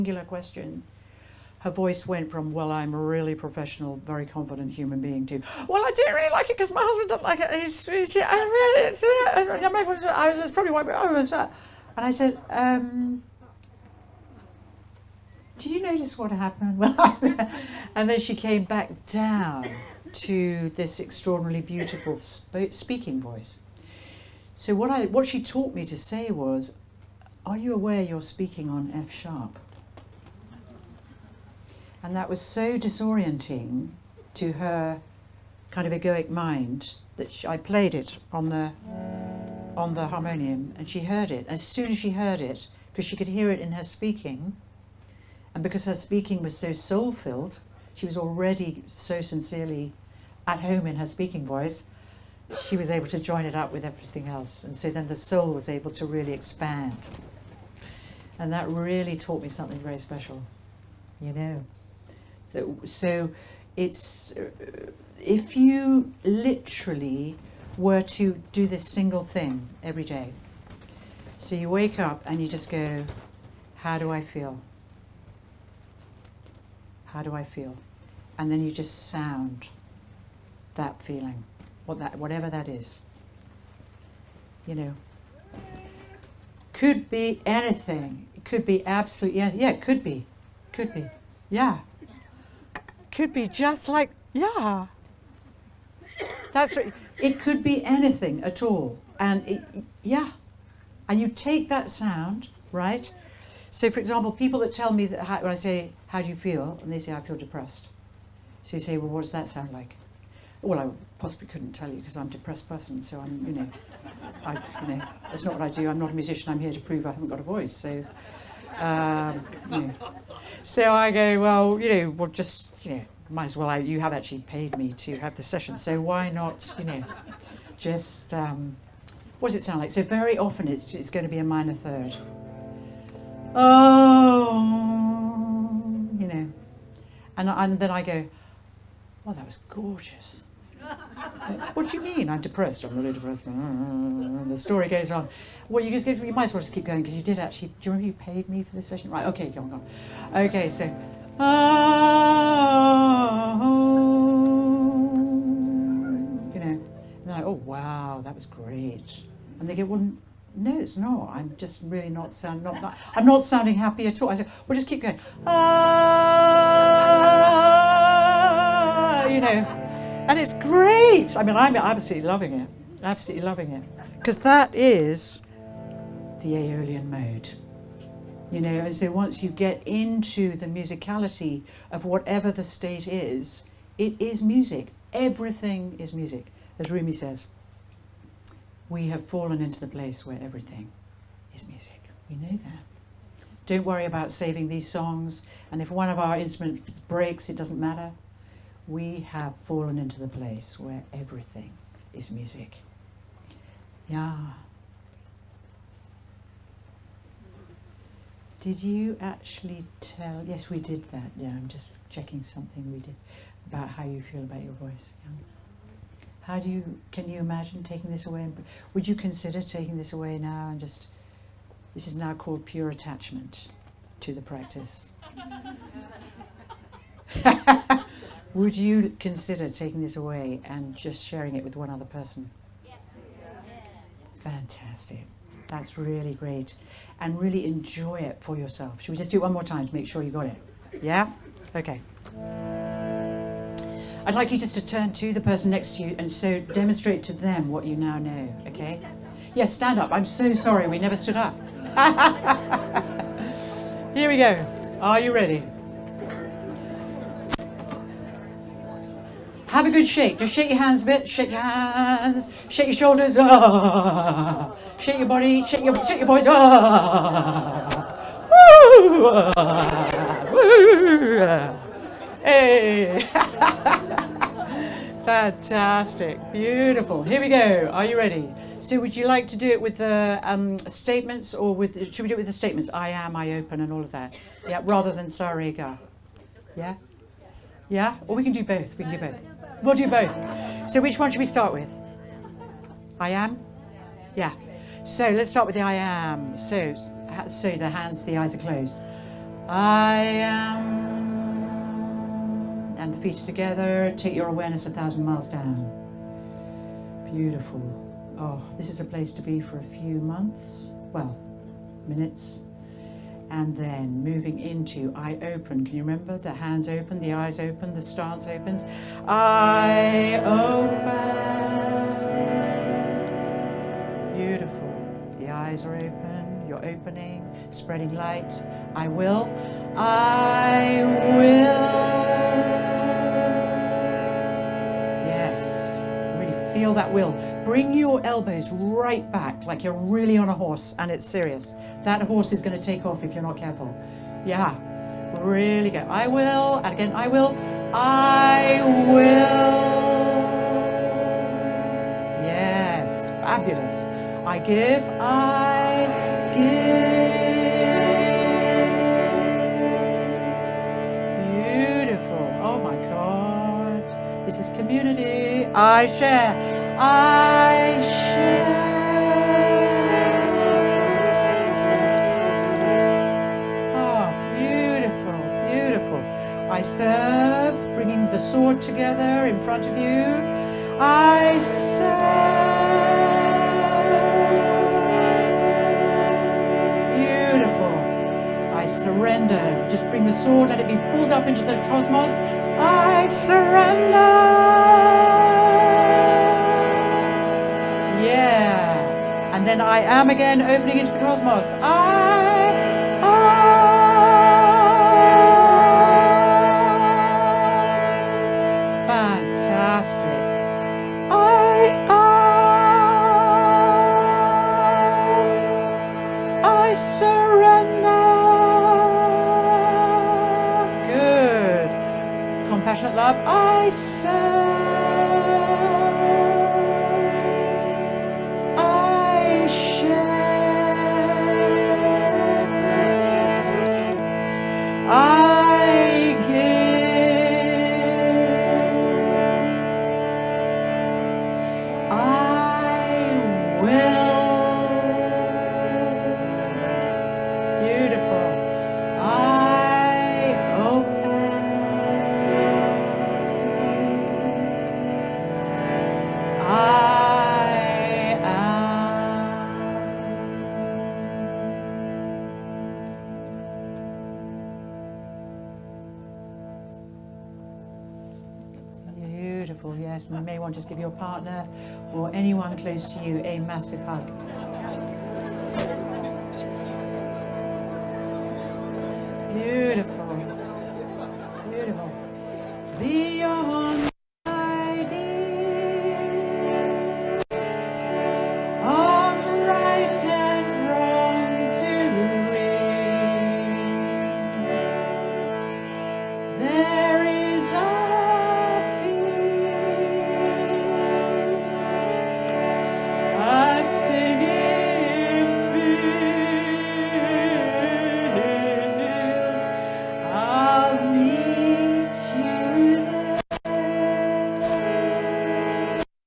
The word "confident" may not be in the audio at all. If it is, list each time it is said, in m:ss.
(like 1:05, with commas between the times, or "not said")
0:04.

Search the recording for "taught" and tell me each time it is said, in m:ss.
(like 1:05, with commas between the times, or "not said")
0:25, 0:59.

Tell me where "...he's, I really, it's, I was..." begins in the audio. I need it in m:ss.
0:07.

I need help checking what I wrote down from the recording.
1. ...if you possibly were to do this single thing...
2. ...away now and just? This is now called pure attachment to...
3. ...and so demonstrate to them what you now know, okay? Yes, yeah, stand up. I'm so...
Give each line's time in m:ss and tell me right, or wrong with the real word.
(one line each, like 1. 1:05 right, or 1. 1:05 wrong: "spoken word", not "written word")
1. 1:05 wrong: "literally", not "possibly"
2. 3:40 right
3. 4:06 right.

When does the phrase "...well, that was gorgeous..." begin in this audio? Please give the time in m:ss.
2:19.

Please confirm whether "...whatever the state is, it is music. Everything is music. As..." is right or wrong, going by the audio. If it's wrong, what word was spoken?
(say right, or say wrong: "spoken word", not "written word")
right.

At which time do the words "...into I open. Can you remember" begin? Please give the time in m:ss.
5:14.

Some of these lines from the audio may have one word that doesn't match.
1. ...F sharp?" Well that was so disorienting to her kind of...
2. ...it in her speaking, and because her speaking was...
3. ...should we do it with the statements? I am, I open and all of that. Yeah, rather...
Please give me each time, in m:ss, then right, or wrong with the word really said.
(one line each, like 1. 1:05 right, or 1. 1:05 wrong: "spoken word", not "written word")
1. 0:28 wrong: "And", not "Well"
2. 0:43 right
3. 4:42 right.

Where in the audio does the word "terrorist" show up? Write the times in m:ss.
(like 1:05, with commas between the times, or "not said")
not said.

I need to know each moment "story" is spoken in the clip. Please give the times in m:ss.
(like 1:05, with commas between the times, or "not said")
2:24.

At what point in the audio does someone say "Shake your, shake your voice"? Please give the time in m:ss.
4:25.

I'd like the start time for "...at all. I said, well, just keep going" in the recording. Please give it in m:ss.
2:44.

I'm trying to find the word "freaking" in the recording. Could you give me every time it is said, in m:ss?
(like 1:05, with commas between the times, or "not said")
not said.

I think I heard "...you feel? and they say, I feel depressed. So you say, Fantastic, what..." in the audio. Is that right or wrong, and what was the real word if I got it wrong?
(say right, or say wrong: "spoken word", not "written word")
wrong: "Well", not "Fantastic".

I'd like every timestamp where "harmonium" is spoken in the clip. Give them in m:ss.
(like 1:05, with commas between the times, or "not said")
0:40.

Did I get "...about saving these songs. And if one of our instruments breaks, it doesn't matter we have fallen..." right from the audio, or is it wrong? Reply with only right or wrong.
right.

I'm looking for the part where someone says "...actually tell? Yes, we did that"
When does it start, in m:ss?
3:29.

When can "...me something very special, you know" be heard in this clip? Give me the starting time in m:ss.
0:59.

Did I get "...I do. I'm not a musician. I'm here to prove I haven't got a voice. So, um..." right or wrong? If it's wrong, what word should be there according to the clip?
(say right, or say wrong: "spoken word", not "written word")
right.